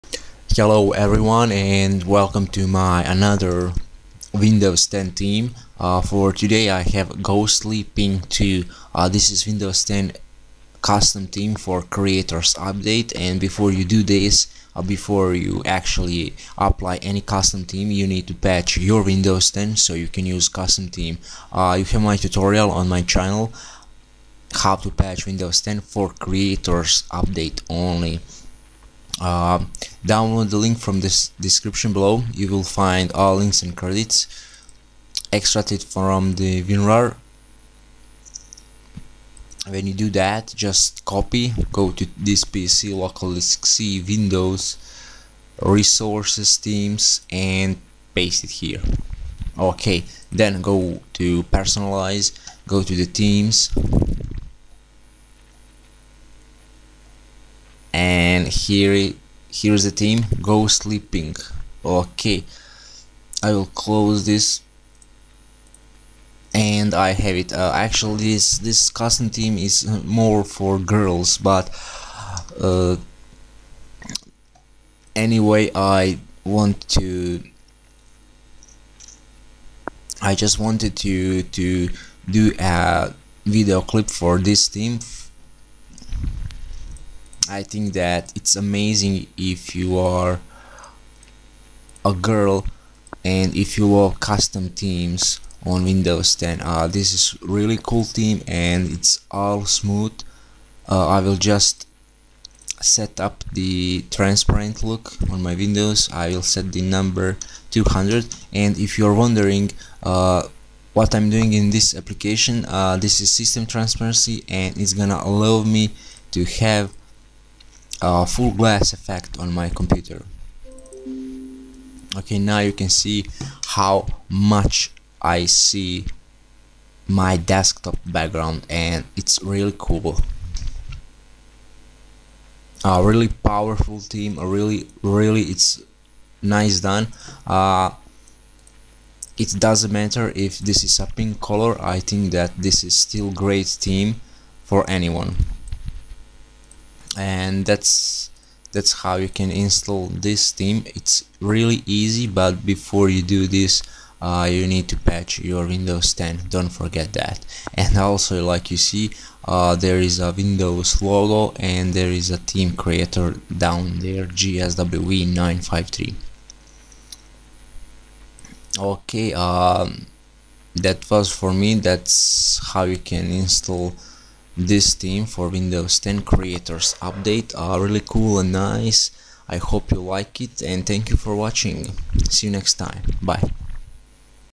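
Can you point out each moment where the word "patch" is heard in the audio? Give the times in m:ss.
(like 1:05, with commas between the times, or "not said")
0:18, 0:24, 2:34.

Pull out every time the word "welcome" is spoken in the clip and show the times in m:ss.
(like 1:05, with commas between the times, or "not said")
0:02.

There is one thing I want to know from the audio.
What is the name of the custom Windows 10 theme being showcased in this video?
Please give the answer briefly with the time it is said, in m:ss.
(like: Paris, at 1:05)
Ghostly Pink 2, at 0:07.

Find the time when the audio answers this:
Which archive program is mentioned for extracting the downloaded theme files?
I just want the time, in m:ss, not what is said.
0:36.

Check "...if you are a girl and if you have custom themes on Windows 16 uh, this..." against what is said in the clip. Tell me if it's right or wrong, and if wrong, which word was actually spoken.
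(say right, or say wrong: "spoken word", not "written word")
wrong: "10", not "16".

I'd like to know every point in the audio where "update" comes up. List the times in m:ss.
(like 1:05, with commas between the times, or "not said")
0:12, 0:27, 2:57.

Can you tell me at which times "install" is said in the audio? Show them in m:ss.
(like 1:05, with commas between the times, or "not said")
2:29, 2:53.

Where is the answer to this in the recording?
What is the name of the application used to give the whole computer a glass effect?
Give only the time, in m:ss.
1:53.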